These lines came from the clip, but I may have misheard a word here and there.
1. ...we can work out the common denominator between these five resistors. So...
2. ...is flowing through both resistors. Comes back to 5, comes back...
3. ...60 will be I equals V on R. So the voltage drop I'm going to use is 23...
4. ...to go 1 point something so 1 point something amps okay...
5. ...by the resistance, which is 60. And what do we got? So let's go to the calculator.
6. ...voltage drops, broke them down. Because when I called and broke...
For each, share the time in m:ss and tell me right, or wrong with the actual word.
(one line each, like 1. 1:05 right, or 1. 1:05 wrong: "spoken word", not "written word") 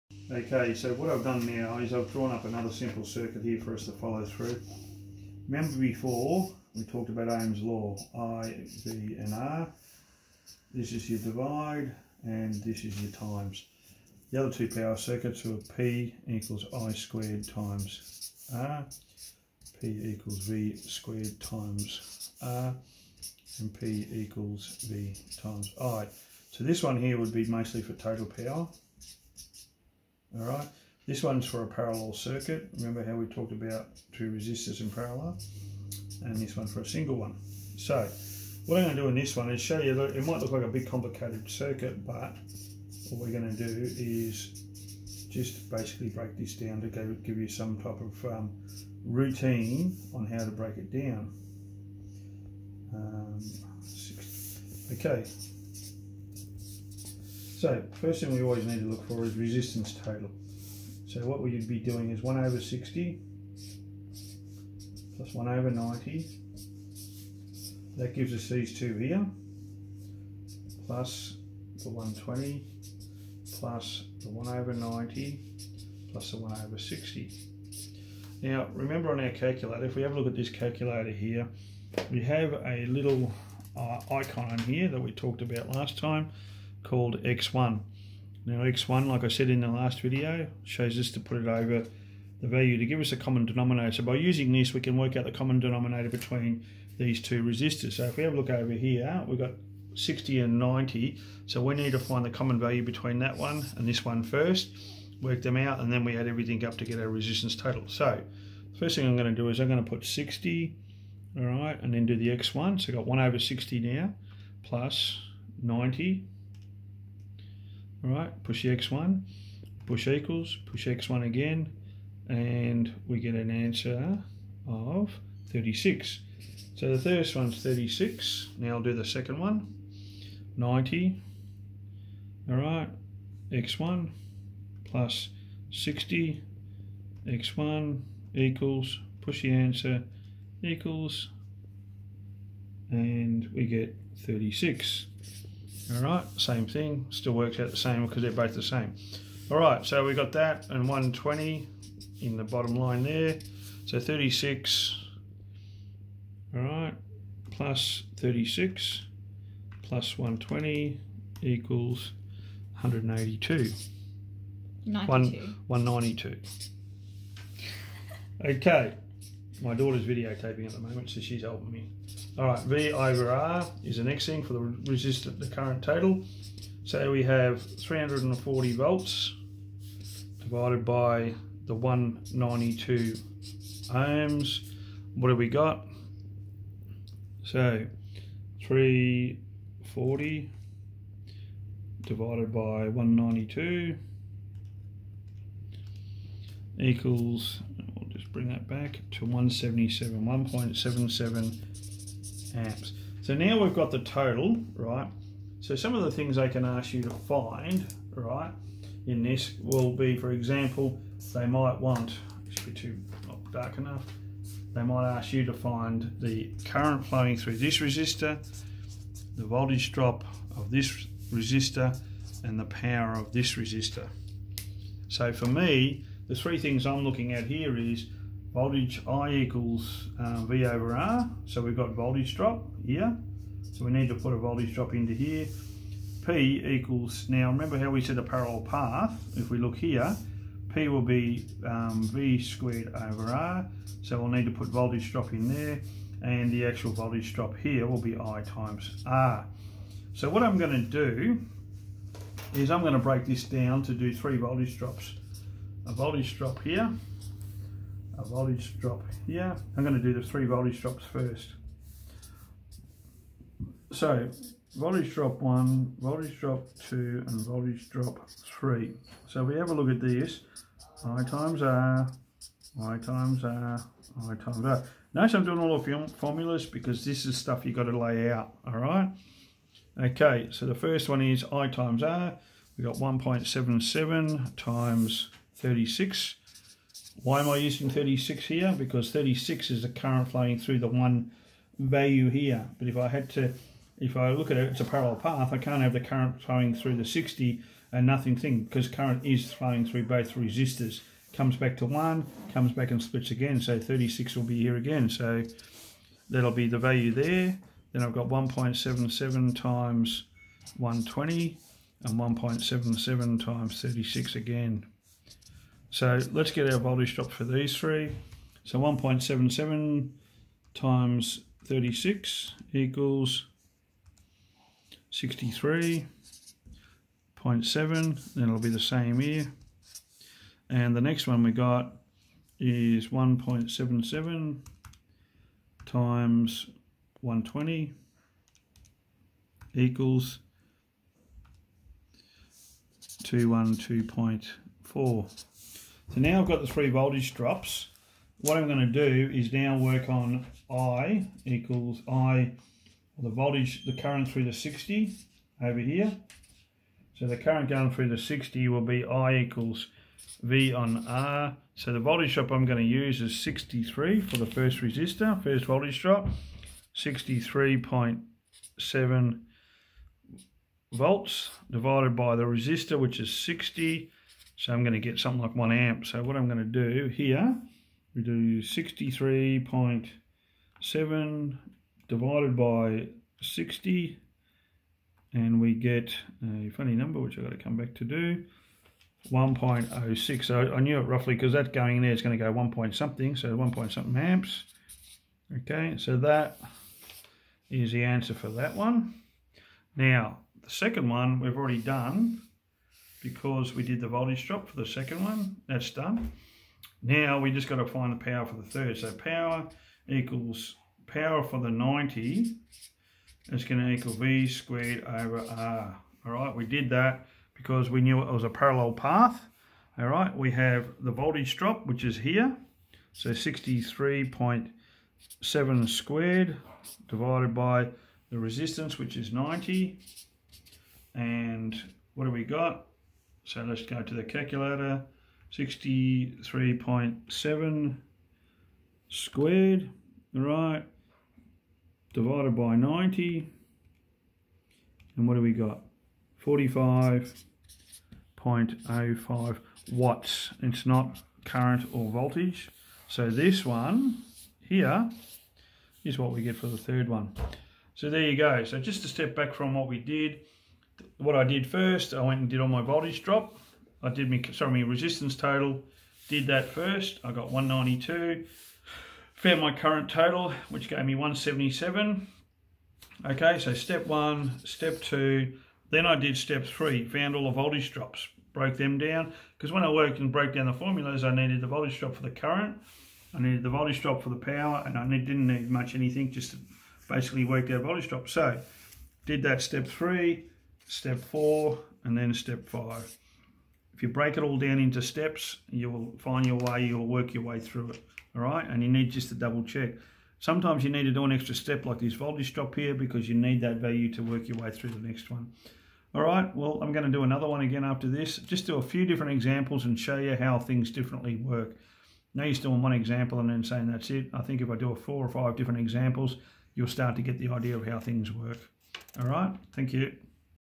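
1. 1:34 wrong: "two", not "five"
2. 4:59 wrong: "1", not "5"
3. 5:58 wrong: "63", not "23"
4. 6:32 right
5. 7:07 wrong: "90", not "60"
6. 7:57 wrong: "worked", not "called".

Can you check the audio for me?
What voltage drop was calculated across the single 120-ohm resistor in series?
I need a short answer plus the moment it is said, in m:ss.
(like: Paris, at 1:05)
212.4, at 5:43.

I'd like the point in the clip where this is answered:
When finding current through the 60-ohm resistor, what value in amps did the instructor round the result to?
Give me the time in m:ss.
6:29.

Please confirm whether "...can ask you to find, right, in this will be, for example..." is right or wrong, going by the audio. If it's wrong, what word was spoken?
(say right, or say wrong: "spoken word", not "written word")
right.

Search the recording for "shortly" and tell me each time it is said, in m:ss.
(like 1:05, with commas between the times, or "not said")
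not said.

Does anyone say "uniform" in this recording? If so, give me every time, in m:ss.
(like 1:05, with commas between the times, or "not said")
not said.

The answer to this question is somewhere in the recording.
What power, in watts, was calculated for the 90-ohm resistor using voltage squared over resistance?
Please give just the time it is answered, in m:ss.
7:26.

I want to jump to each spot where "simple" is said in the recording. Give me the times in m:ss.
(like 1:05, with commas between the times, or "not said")
0:02.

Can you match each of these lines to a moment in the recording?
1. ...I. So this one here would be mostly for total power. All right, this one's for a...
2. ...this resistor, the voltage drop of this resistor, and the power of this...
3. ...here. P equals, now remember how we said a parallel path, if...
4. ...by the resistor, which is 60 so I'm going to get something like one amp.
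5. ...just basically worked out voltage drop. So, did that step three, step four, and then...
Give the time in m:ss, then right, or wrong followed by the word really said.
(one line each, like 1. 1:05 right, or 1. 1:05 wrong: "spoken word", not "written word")
1. 0:25 right
2. 3:37 right
3. 3:55 right
4. 6:12 right
5. 8:06 right.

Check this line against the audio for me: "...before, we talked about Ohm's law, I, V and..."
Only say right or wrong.
right.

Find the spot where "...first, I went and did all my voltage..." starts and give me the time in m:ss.
7:41.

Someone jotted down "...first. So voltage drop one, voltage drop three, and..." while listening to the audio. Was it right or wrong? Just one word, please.
wrong.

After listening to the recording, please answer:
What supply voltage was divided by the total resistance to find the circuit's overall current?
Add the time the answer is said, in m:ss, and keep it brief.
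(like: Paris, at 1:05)
340 volts, at 2:57.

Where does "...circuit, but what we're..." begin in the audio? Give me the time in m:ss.
0:41.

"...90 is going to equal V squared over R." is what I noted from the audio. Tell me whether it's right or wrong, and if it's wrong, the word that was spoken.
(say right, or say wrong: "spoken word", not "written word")
right.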